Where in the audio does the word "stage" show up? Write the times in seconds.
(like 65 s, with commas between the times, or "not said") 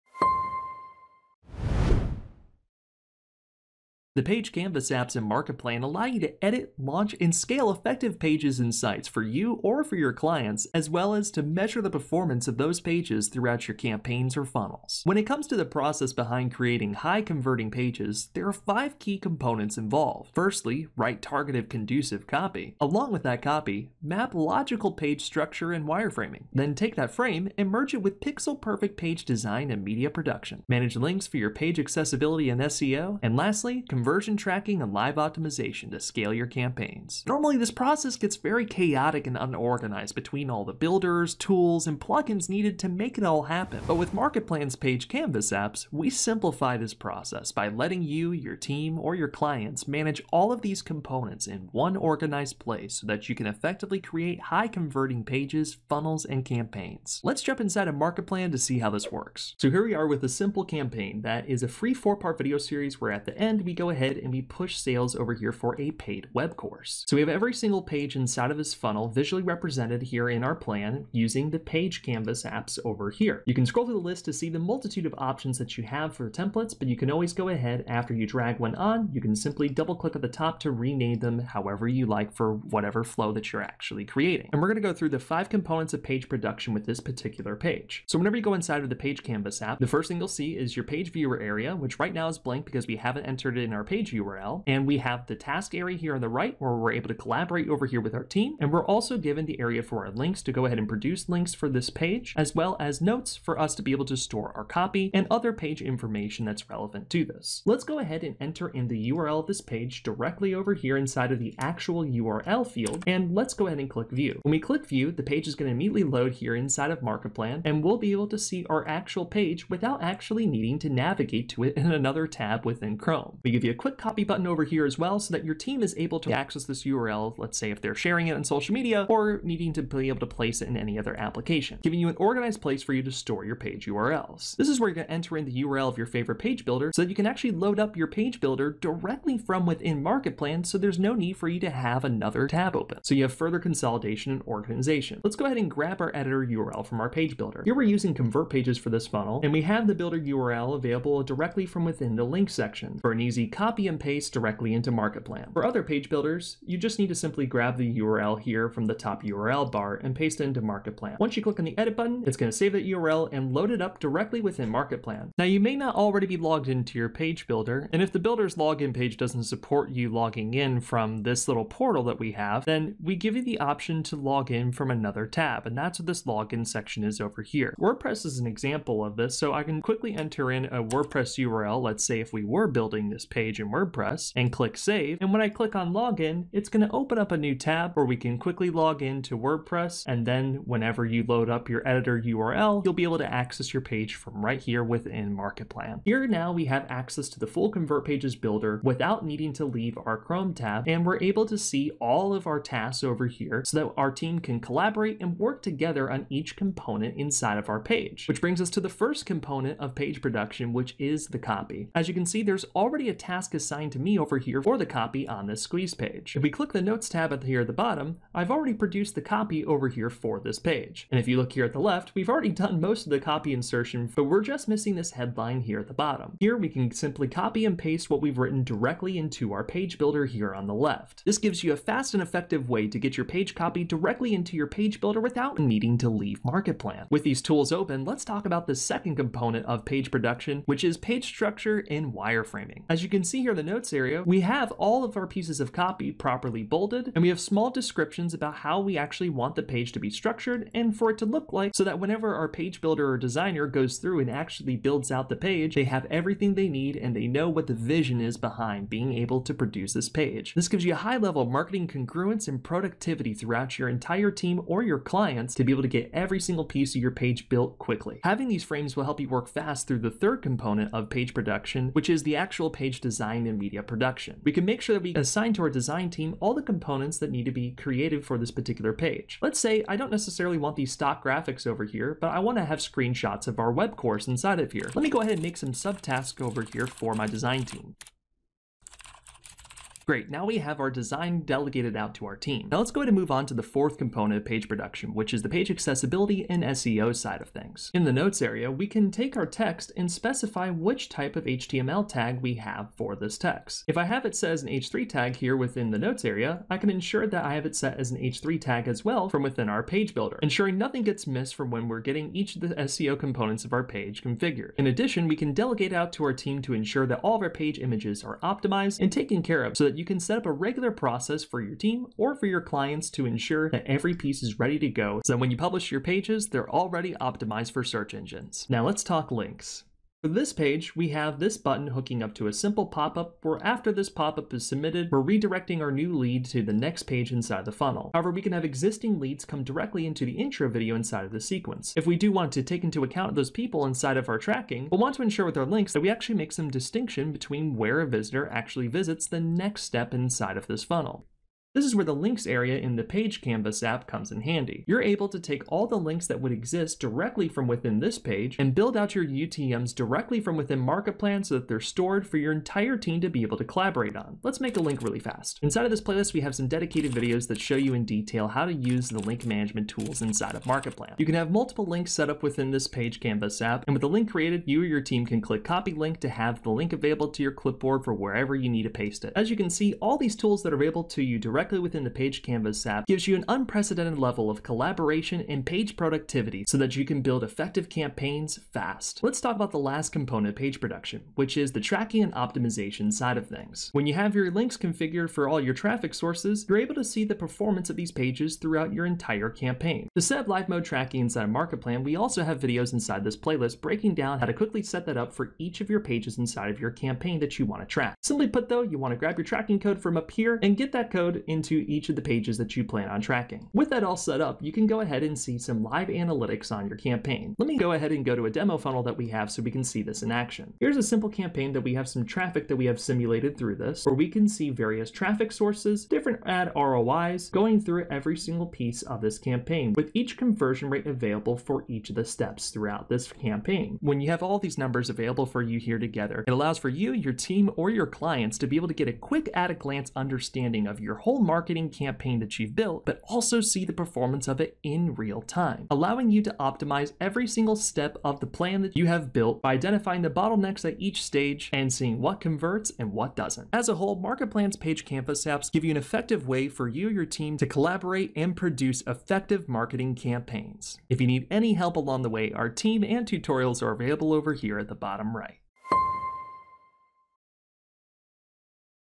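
451 s.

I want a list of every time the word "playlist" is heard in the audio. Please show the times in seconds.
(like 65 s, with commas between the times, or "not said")
366 s, 403 s.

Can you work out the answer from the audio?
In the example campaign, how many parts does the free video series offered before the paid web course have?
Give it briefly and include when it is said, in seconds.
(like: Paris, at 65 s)
4, at 61 s.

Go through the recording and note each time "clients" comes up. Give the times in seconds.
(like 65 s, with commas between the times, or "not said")
10 s, 49 s, 264 s, 322 s, 438 s.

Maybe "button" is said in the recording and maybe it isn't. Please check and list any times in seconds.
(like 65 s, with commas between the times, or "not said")
124 s, 161 s, 331 s.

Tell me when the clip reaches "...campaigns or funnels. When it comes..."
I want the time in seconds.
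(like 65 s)
13 s.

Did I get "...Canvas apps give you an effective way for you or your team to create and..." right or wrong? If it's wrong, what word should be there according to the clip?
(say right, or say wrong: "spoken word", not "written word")
wrong: "collaborate", not "create".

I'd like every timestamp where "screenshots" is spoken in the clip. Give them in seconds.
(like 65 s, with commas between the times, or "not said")
282 s.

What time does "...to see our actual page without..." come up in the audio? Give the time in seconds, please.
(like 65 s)
118 s.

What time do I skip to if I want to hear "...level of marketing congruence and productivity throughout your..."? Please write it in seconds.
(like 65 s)
261 s.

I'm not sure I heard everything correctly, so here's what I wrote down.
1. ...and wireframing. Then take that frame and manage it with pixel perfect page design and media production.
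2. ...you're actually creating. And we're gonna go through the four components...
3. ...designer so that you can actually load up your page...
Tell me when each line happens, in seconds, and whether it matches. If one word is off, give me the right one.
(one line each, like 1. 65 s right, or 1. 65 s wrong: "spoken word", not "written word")
1. 25 s wrong: "merge", not "manage"
2. 83 s wrong: "five", not "four"
3. 136 s wrong: "builder", not "designer".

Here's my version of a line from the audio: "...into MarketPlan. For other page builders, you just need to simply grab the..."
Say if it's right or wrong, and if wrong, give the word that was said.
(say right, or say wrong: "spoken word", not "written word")
right.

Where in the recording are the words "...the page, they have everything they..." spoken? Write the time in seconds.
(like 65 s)
255 s.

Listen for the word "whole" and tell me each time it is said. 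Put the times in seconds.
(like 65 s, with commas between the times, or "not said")
441 s, 453 s.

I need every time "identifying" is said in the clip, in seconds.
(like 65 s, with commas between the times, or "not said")
449 s.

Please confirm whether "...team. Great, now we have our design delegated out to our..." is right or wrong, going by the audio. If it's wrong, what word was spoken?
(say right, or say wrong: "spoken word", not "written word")
right.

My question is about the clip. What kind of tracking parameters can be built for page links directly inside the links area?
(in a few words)
UTMs.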